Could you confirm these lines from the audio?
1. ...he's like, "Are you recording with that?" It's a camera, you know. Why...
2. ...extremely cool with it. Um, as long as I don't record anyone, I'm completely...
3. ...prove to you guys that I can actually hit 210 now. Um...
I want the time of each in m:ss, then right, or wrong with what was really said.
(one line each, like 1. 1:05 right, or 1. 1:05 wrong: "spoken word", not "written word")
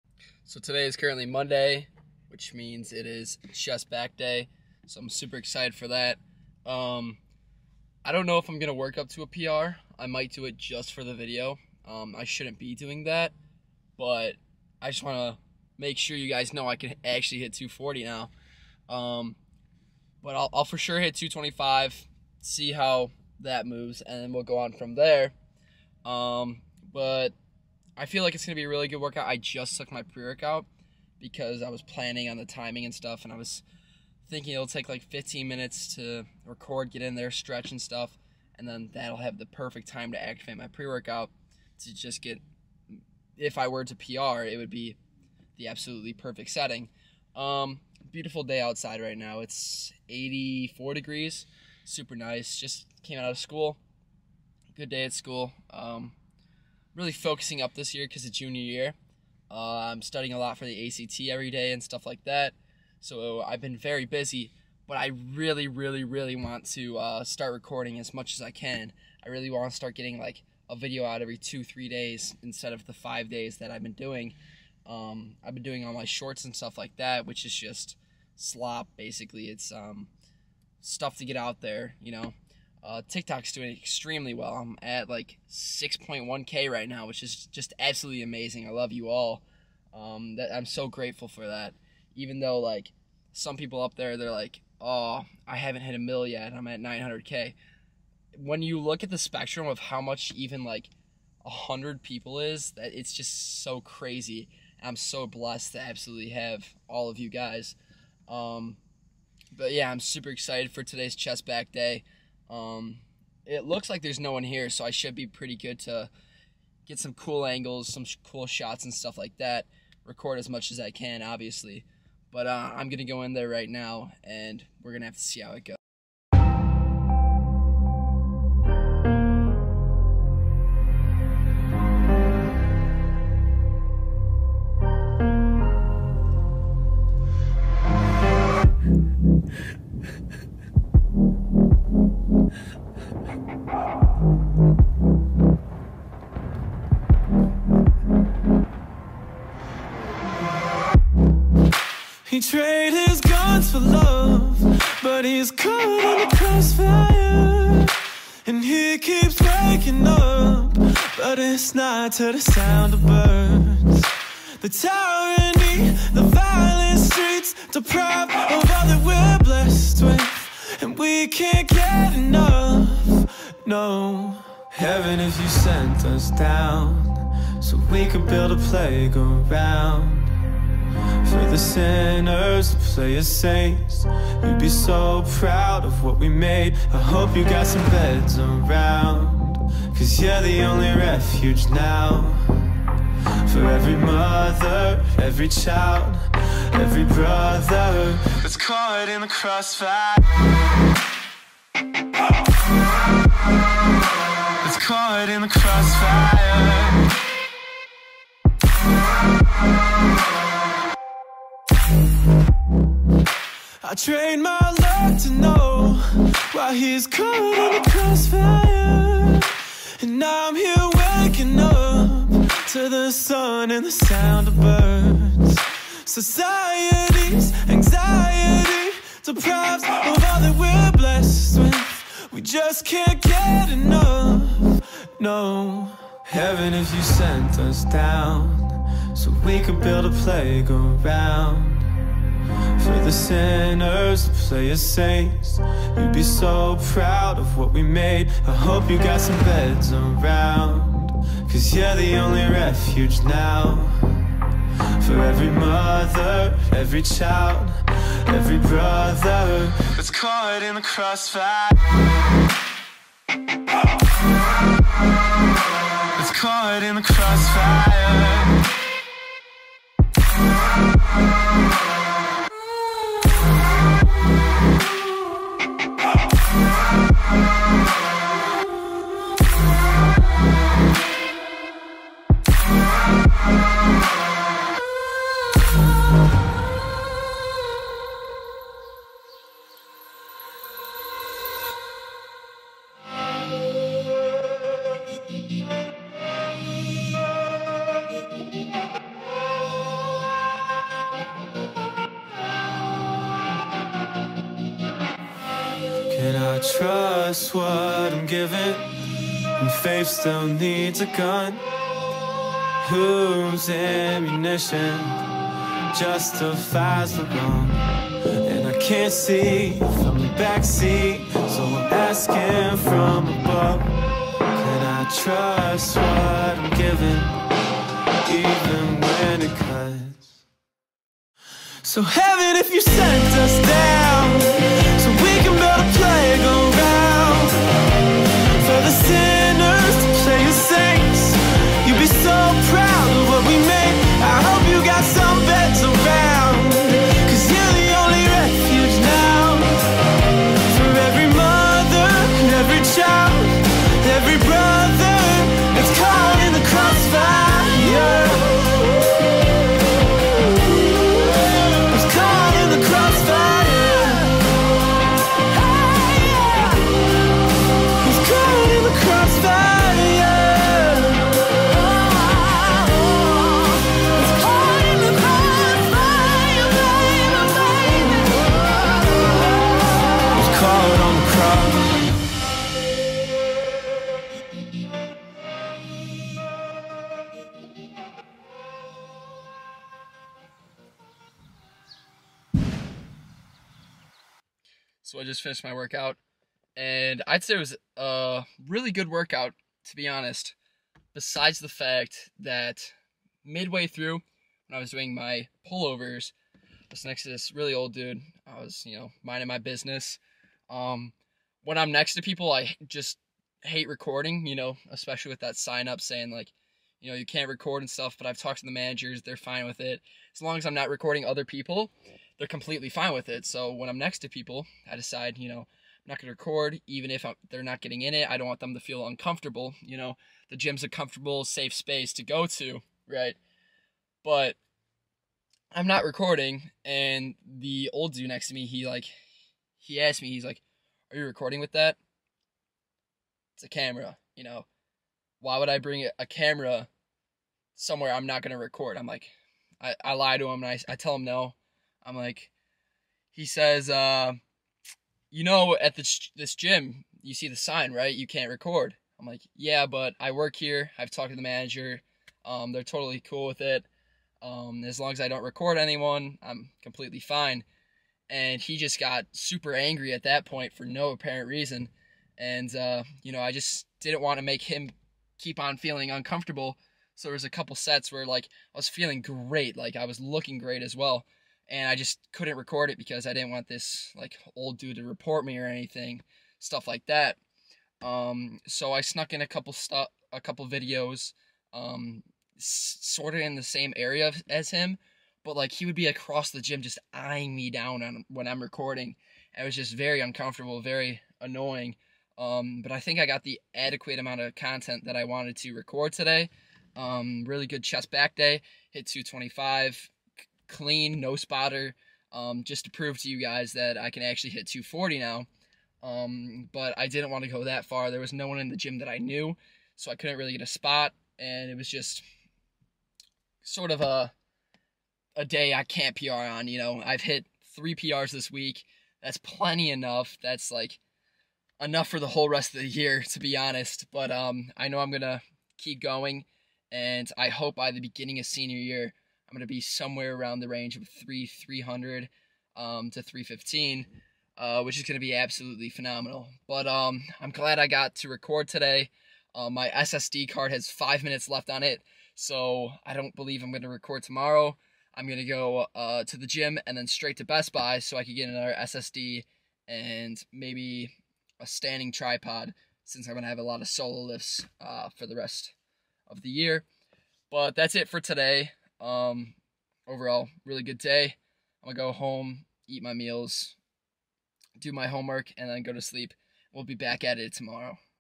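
1. 7:20 right
2. 7:42 wrong: "totally", not "extremely"
3. 8:32 wrong: "240", not "210".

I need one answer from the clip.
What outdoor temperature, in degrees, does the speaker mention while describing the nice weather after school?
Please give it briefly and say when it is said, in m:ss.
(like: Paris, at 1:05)
84, at 0:50.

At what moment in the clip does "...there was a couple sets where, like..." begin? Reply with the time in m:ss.
7:57.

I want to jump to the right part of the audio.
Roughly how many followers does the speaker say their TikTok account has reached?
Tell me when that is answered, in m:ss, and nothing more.
1:25.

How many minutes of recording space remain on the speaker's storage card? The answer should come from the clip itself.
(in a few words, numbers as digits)
5.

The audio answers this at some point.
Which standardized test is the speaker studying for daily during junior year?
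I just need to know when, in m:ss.
1:00.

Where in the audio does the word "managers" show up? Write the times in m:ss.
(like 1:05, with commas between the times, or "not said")
6:58, 7:41.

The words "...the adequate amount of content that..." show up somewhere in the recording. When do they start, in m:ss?
8:23.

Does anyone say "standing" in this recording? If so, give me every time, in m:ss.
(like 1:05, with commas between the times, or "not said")
9:21.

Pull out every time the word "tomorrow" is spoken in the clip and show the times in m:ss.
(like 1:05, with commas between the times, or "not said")
9:14, 9:37.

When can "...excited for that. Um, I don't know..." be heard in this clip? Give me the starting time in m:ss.
0:05.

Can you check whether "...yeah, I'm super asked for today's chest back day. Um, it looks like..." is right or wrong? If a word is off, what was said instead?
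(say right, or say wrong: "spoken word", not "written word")
wrong: "excited", not "asked".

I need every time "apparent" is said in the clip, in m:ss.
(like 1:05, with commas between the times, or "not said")
7:51.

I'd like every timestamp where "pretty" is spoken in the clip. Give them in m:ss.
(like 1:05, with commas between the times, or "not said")
1:55.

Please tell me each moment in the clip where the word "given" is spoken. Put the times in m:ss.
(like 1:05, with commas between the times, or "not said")
not said.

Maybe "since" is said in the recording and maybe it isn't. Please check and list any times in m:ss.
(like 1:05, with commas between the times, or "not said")
9:23.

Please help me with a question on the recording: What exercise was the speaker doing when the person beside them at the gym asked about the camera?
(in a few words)
Pullovers.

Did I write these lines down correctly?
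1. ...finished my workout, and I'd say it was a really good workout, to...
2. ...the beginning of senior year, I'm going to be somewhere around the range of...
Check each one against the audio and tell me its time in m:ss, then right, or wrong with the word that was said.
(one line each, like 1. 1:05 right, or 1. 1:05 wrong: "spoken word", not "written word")
1. 6:35 right
2. 8:57 right.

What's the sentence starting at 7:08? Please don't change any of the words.
I don't want them to feel uncomfortable.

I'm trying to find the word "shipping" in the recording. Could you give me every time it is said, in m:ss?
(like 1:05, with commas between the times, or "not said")
not said.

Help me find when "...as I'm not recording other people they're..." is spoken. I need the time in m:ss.
7:00.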